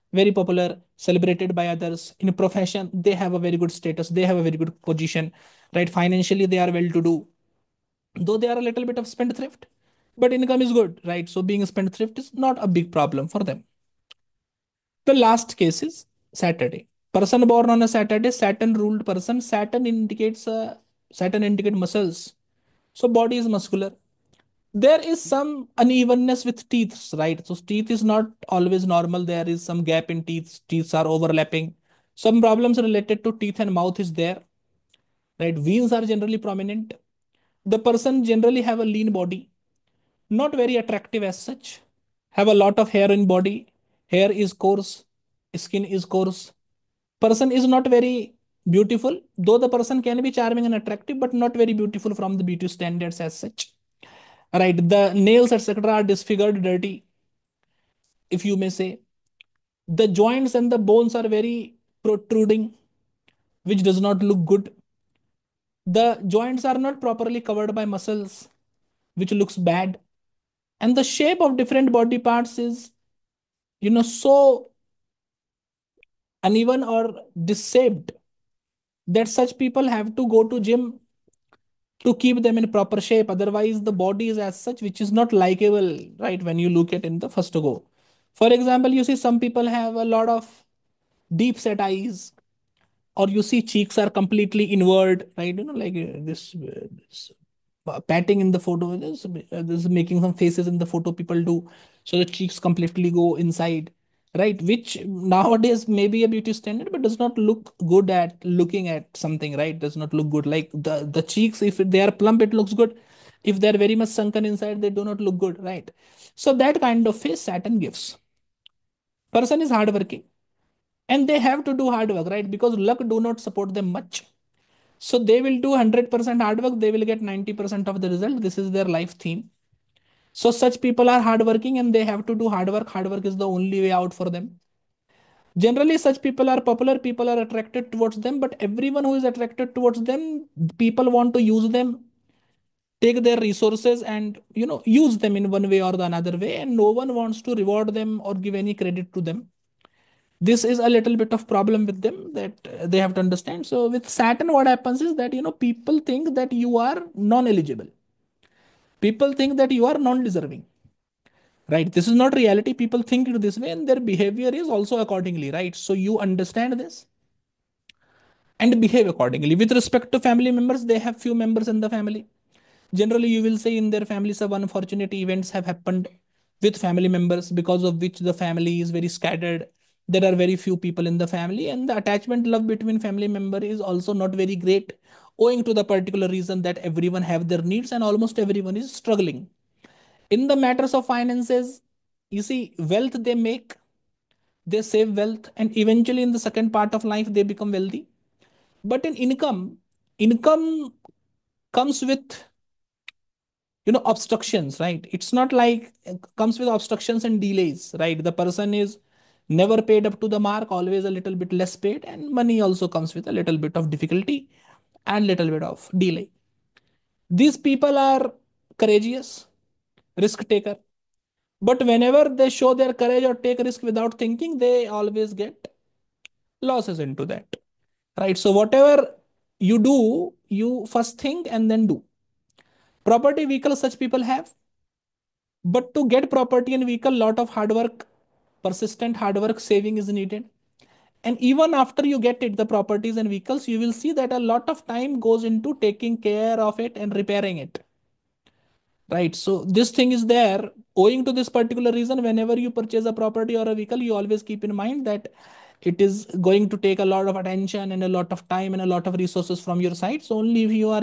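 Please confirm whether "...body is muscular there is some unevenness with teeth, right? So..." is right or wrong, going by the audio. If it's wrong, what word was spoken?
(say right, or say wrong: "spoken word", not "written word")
right.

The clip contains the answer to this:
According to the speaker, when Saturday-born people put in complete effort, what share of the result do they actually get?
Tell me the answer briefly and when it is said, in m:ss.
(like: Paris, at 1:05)
90%, at 2:07.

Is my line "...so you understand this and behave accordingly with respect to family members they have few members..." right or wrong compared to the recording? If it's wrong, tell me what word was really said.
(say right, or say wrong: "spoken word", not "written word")
right.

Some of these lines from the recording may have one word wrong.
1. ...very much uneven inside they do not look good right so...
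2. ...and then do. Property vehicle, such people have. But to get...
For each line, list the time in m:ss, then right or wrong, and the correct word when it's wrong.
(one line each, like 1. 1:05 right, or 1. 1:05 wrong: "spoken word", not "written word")
1. 1:53 wrong: "sunken", not "uneven"
2. 3:51 right.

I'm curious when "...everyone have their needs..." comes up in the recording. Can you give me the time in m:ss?
3:06.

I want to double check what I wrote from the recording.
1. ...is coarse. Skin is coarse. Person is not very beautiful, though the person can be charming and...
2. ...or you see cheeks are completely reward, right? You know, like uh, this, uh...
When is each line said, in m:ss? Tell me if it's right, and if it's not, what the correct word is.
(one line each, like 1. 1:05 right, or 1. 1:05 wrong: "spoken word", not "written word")
1. 0:44 right
2. 1:33 wrong: "inward", not "reward".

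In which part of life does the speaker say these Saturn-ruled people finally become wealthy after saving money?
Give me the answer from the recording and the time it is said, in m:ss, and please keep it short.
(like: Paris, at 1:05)
second part of life, at 3:16.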